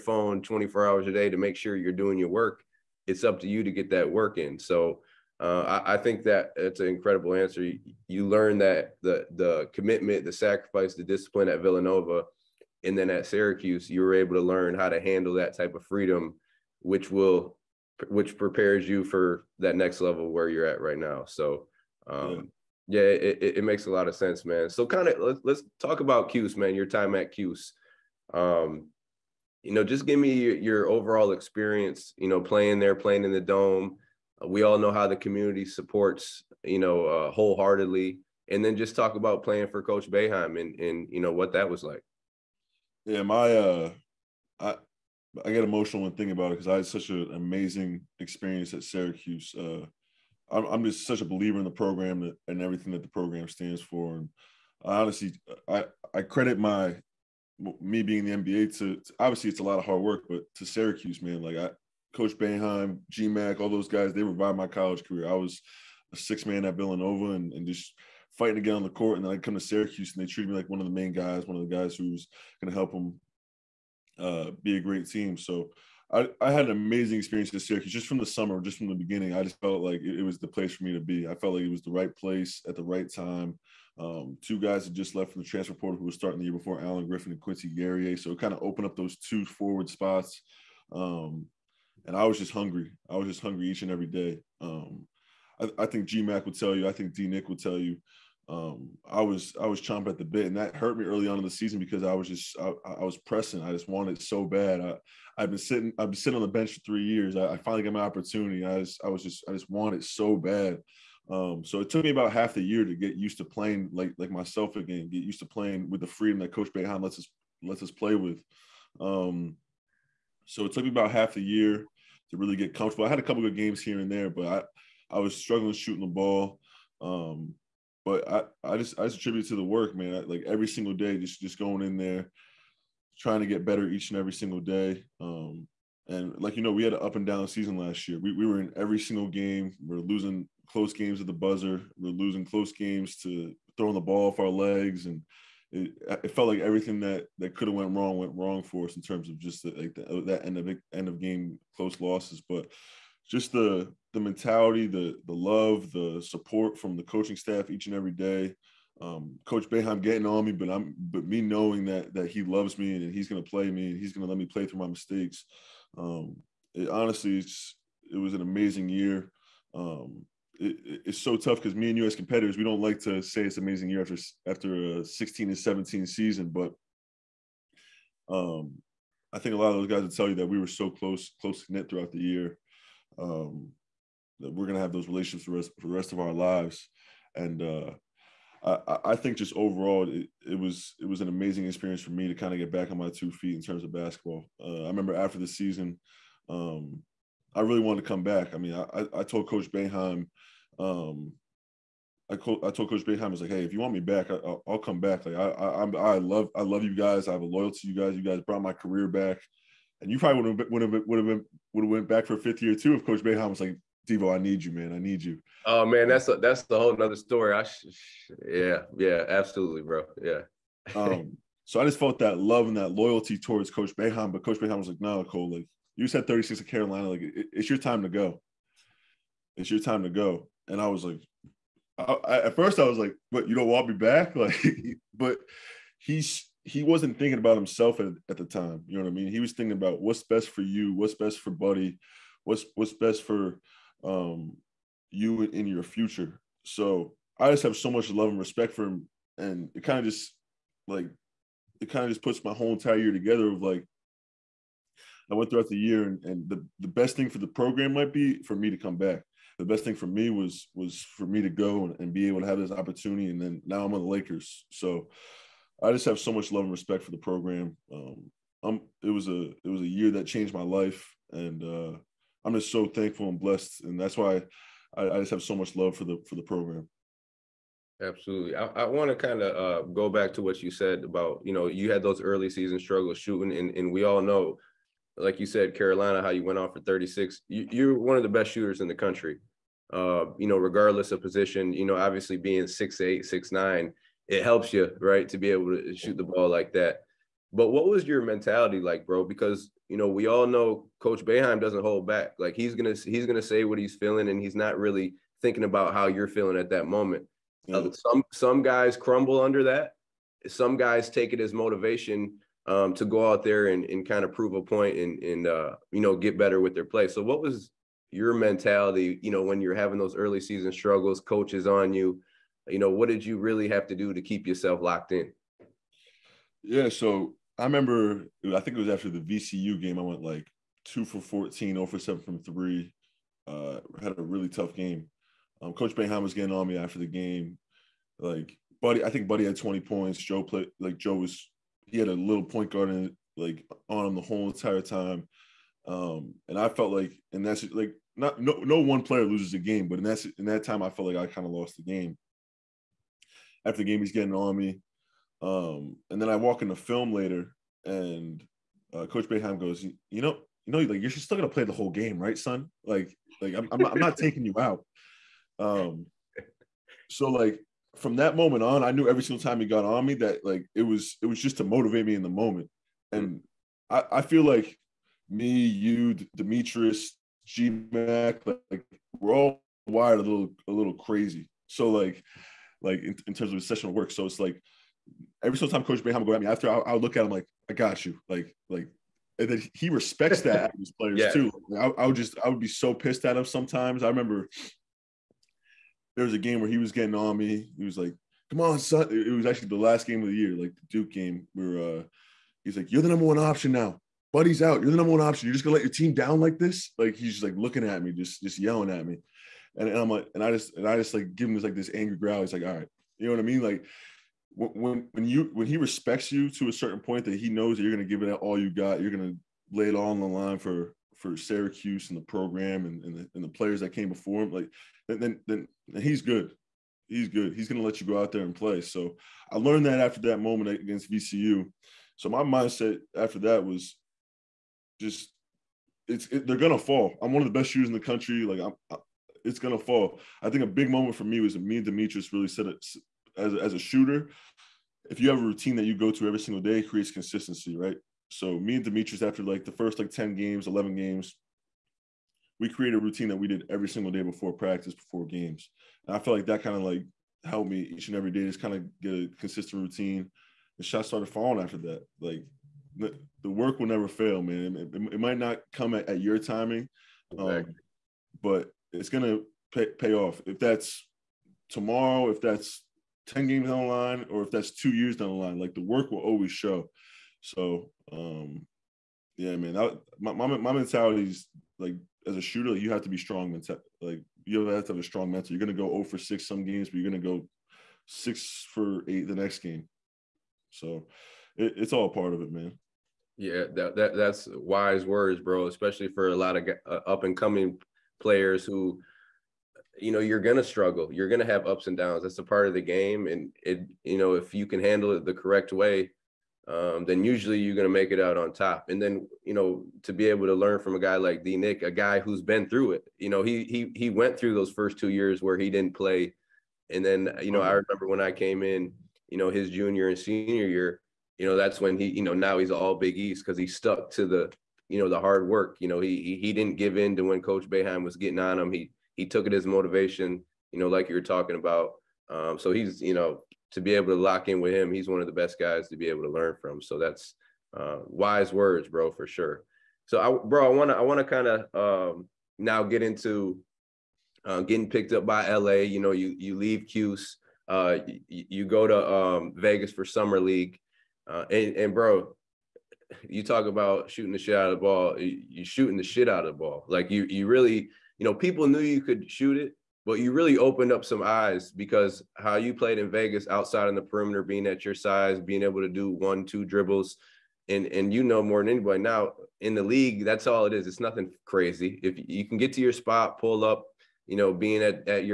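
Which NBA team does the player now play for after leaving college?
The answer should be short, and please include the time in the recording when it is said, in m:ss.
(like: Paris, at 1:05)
Lakers, at 4:24.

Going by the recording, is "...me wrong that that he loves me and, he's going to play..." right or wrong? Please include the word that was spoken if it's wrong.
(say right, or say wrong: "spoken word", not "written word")
wrong: "knowing", not "wrong".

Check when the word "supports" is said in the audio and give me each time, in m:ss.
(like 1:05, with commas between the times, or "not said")
0:35, 2:36.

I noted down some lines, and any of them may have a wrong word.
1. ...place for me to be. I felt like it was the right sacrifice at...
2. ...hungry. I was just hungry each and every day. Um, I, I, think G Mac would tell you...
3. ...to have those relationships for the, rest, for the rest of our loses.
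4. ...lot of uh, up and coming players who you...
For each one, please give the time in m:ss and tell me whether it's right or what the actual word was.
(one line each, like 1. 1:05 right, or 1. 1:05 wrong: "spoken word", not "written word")
1. 1:20 wrong: "place", not "sacrifice"
2. 1:32 right
3. 3:04 wrong: "lives", not "loses"
4. 8:16 right.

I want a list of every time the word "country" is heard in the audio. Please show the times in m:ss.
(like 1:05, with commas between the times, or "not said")
4:48, 7:17.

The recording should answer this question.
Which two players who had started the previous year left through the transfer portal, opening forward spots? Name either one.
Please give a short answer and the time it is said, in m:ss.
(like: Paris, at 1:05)
Alan Griffin, at 1:26.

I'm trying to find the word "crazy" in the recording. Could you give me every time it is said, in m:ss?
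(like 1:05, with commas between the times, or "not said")
6:20, 9:31.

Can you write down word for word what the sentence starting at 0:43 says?
Yeah, my, uh, I, I get emotional when thinking about it because I had such an amazing experience at Syracuse.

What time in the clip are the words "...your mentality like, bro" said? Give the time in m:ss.
4:58.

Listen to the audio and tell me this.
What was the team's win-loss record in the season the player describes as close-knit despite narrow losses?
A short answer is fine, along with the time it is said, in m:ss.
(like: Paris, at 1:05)
16-17, at 2:55.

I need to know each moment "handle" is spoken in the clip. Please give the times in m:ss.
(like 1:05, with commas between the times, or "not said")
0:15, 8:24.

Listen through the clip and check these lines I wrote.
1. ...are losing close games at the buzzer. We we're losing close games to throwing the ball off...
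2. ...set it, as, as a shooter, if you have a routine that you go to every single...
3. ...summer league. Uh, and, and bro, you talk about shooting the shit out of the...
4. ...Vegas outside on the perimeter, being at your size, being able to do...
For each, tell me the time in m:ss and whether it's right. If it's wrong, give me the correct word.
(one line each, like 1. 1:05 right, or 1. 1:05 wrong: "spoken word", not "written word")
1. 2:19 right
2. 7:22 right
3. 9:10 right
4. 9:23 right.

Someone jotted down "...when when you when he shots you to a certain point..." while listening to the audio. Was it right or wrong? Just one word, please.
wrong.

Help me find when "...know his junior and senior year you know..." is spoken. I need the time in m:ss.
8:39.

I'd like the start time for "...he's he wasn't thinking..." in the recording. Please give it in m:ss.
3:55.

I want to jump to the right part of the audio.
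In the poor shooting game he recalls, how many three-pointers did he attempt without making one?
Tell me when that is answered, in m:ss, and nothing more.
5:31.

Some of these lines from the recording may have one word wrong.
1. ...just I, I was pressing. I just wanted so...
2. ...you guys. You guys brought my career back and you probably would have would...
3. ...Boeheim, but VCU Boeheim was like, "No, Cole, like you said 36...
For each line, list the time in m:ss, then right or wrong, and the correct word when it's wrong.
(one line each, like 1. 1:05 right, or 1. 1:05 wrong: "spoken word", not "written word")
1. 1:42 right
2. 3:27 right
3. 3:43 wrong: "Coach", not "VCU".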